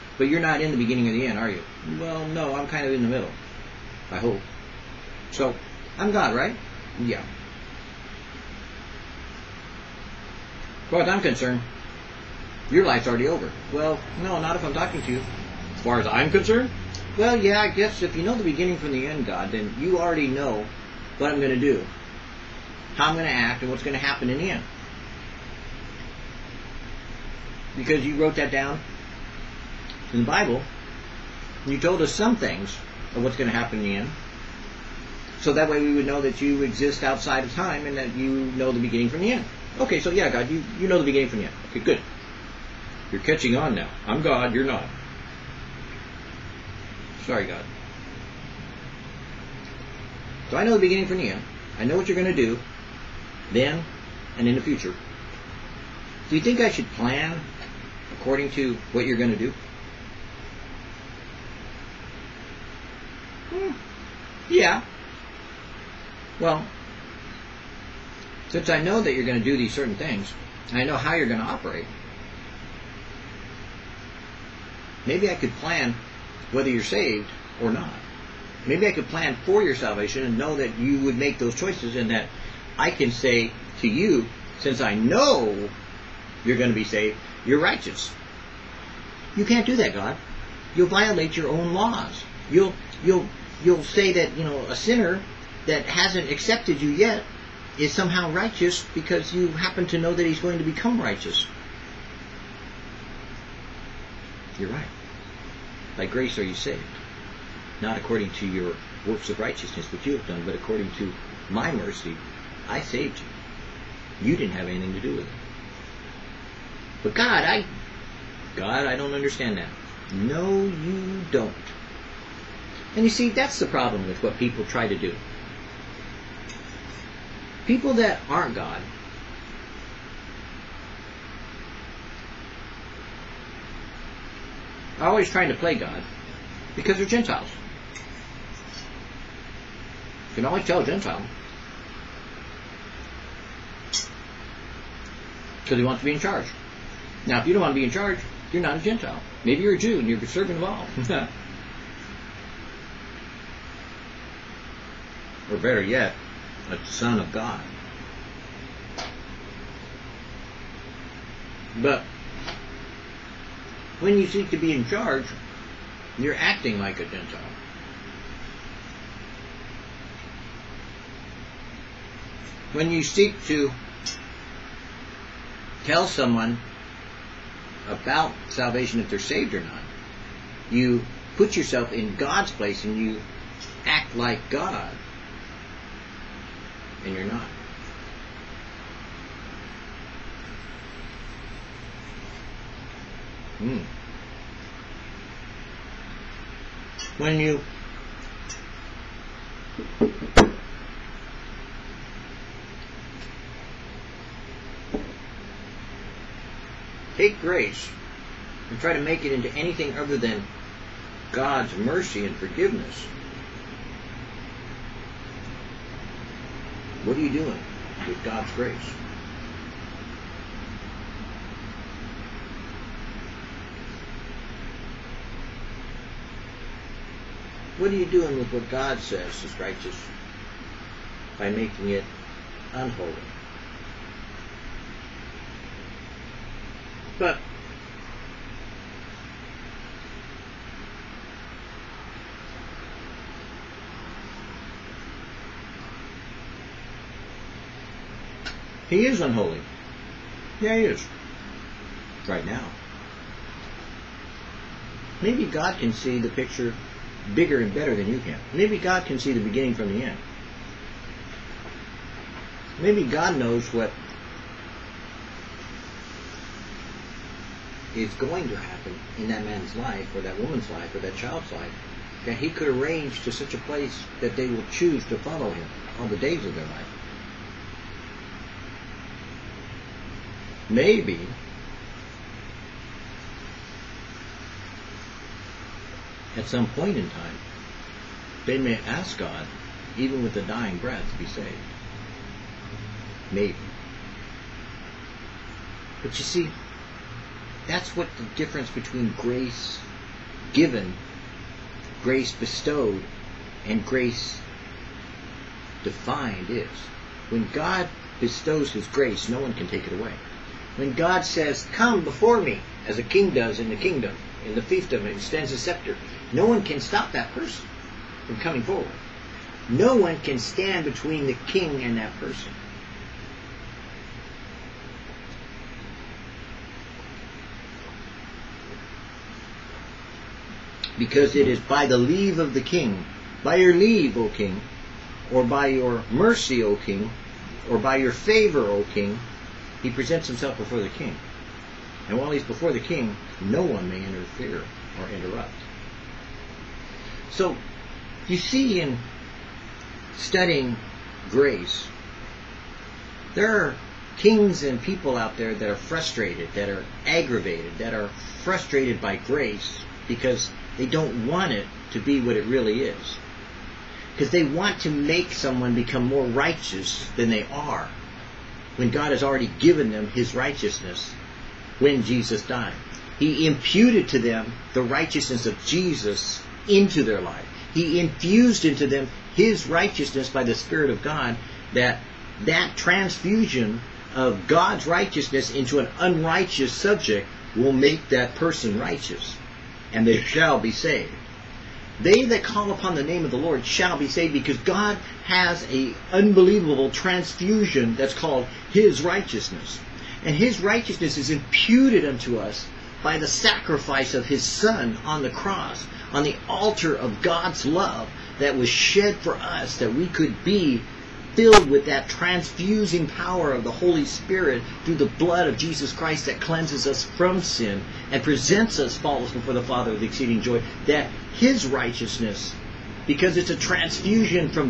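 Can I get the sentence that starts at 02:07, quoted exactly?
People that aren't God are always trying to play God because they're Gentiles.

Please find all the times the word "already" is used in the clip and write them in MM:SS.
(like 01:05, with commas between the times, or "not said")
00:13, 00:19, 06:09.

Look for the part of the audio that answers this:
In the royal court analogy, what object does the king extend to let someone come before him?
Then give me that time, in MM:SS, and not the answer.
05:15.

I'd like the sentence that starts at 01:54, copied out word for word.
You didn't have anything to do with it.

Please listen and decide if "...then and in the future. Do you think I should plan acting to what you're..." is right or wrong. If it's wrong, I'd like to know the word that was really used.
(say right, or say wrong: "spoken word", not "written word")
wrong: "according", not "acting".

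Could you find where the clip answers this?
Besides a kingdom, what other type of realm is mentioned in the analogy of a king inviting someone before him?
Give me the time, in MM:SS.
05:14.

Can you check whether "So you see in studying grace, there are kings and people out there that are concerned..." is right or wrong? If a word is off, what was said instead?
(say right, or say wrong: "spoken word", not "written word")
wrong: "frustrated", not "concerned".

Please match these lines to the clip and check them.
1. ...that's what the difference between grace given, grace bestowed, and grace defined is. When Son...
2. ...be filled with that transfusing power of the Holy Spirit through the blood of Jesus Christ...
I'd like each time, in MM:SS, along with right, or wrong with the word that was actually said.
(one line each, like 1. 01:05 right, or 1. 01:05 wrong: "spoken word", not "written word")
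1. 04:57 wrong: "God", not "Son"
2. 06:50 right.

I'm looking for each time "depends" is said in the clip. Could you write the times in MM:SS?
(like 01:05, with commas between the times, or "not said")
not said.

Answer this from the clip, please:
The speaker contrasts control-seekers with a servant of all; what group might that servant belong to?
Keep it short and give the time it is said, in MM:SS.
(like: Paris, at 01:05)
Jew, at 02:29.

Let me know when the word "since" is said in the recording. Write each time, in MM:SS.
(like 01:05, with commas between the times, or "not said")
01:08, 01:24.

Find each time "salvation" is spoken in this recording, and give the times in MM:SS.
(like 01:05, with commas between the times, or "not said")
01:19, 02:58.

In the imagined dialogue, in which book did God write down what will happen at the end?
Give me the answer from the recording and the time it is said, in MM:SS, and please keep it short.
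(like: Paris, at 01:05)
The Bible, at 00:30.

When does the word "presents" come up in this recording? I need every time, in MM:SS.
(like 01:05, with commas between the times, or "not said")
05:39, 06:58.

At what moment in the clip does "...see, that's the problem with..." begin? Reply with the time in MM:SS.
02:03.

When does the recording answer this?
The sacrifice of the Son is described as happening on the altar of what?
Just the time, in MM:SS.
06:47.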